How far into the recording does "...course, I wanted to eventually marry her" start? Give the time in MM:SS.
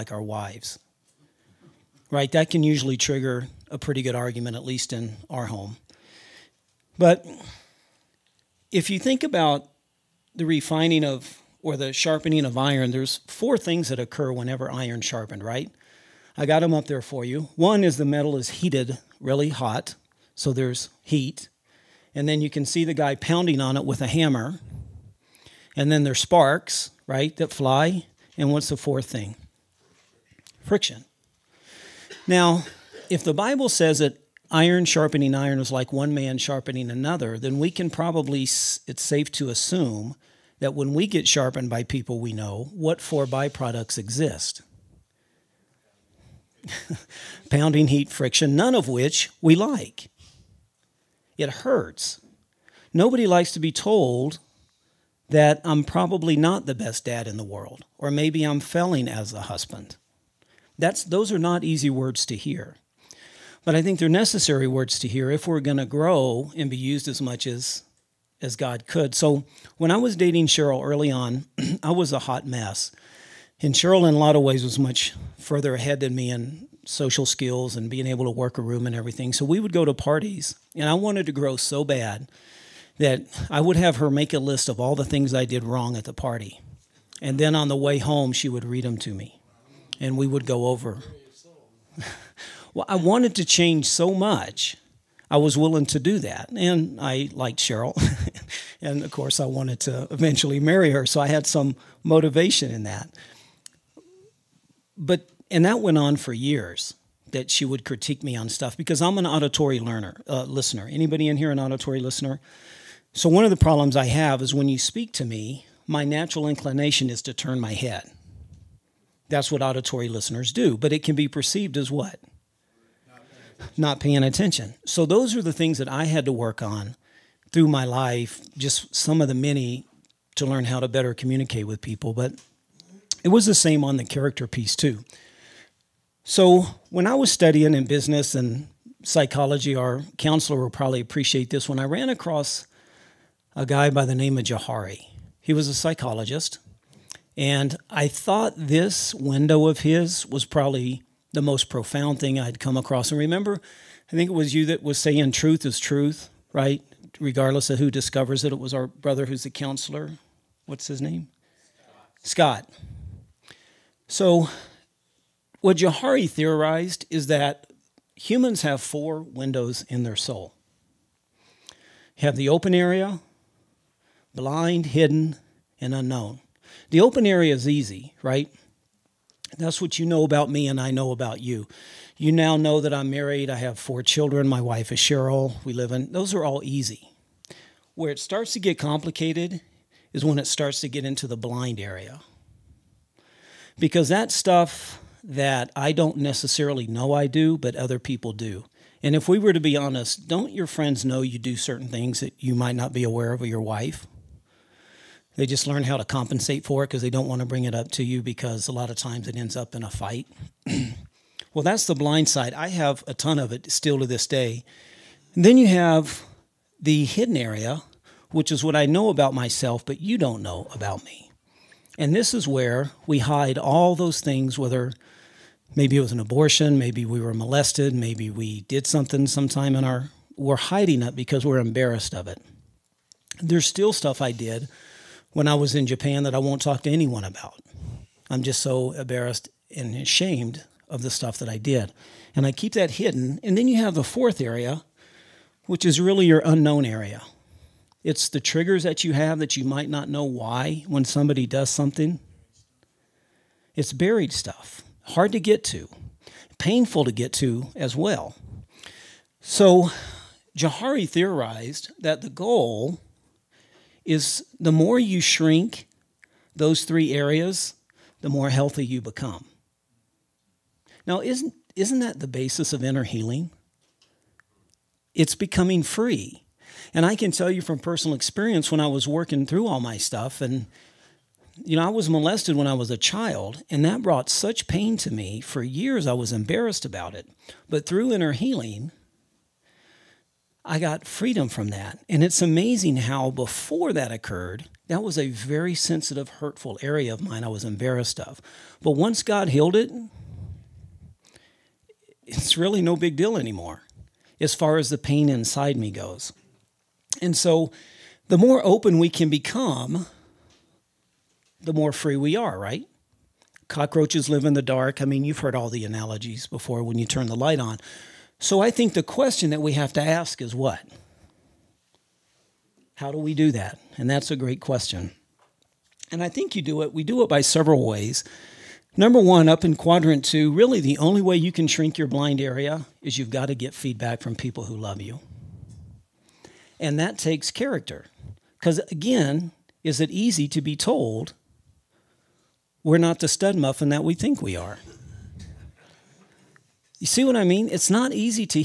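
01:39.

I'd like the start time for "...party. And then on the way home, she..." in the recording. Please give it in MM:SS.
01:26.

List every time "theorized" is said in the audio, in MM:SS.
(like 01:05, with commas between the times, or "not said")
02:46, 04:21.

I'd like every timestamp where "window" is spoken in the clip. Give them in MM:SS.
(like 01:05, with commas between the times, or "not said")
02:29, 02:49.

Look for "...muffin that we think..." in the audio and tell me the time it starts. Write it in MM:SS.
05:43.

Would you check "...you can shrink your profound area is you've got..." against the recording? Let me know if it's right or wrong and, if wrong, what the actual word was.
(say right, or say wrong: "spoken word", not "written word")
wrong: "blind", not "profound".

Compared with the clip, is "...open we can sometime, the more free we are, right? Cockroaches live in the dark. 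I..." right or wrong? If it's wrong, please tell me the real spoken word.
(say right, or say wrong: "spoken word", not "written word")
wrong: "become", not "sometime".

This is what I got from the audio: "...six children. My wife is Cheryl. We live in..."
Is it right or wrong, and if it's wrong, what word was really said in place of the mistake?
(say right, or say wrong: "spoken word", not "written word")
wrong: "four", not "six".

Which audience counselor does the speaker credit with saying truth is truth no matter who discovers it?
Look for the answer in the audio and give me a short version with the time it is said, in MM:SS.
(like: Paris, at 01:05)
Scott, at 02:42.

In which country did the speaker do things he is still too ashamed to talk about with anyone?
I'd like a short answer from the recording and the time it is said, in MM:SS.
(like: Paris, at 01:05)
Japan, at 03:55.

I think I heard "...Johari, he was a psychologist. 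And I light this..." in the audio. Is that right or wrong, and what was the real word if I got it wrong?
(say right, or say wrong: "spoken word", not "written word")
wrong: "thought", not "light".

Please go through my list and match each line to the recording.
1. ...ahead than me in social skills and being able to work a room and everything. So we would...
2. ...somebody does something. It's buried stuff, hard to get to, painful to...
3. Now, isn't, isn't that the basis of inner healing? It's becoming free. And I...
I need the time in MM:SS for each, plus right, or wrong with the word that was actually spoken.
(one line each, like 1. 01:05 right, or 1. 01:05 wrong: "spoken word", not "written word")
1. 01:15 right
2. 04:11 right
3. 04:31 right.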